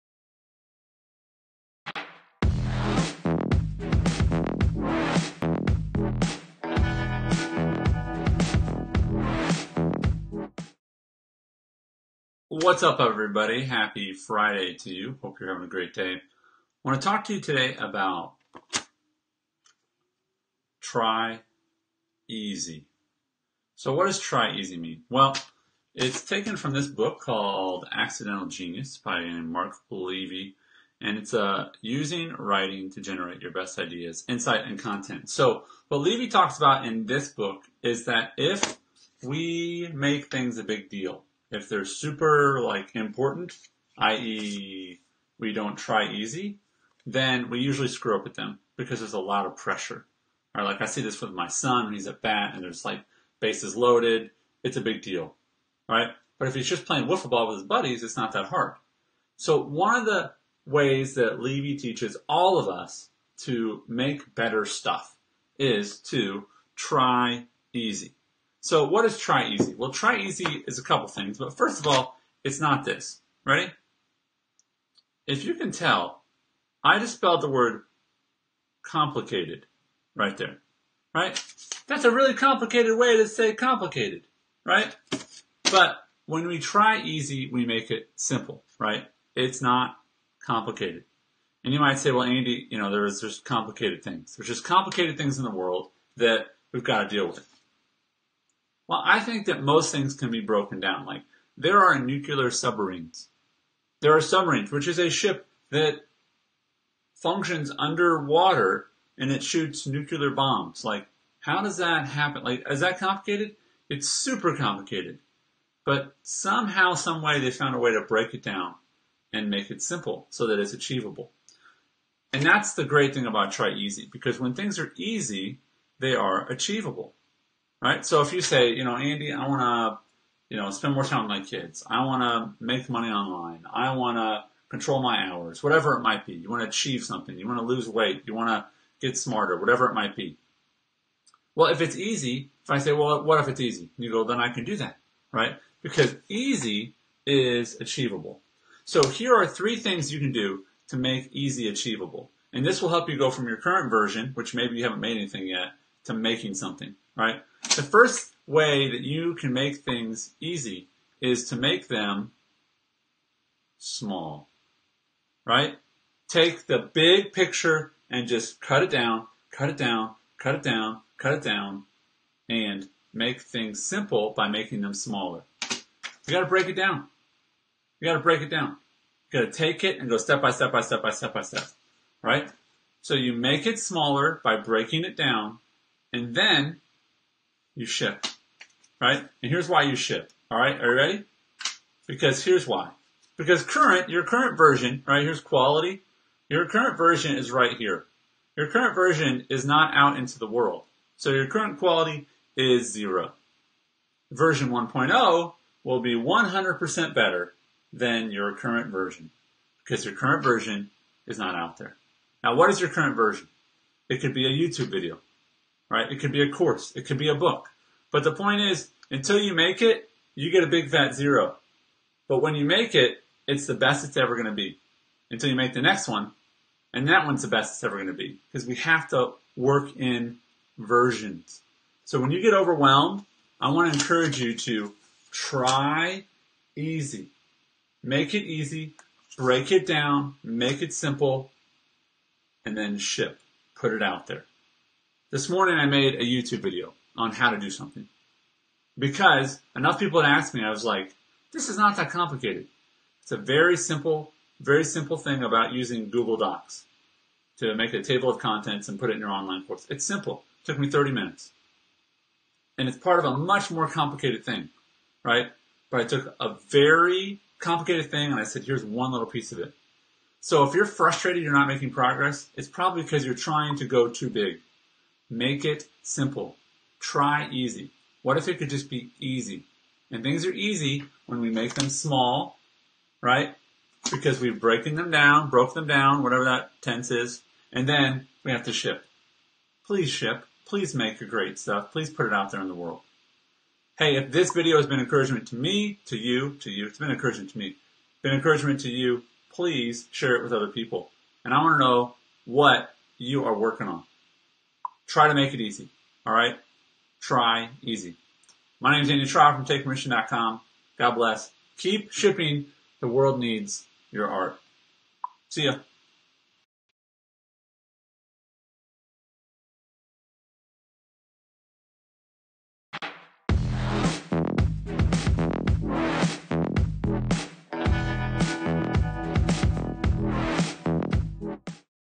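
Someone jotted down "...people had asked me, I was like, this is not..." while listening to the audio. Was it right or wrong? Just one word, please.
right.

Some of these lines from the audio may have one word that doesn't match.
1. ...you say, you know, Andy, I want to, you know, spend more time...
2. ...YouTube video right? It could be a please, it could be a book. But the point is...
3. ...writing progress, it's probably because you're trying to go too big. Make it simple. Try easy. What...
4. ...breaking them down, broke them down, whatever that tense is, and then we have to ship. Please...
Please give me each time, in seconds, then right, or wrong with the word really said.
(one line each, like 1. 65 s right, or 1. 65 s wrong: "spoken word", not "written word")
1. 128 s right
2. 214 s wrong: "course", not "please"
3. 271 s wrong: "making", not "writing"
4. 284 s right.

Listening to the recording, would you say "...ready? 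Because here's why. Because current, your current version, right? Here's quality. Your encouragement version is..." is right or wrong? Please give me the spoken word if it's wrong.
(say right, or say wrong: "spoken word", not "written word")
wrong: "current", not "encouragement".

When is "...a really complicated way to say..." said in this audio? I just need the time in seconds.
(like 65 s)
82 s.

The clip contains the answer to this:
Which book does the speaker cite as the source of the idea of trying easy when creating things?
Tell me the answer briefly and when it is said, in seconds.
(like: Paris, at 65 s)
Accidental Genius, at 27 s.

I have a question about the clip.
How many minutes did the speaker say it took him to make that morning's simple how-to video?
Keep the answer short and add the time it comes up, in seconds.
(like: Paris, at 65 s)
30, at 260 s.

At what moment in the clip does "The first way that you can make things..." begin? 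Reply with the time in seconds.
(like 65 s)
157 s.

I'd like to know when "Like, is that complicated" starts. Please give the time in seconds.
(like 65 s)
112 s.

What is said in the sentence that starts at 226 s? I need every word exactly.
And that one's the best it's ever going to be because we have to work in versions.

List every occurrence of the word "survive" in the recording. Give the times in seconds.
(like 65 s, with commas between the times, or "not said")
not said.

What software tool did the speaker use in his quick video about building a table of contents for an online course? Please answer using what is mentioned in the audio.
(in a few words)
Google Docs.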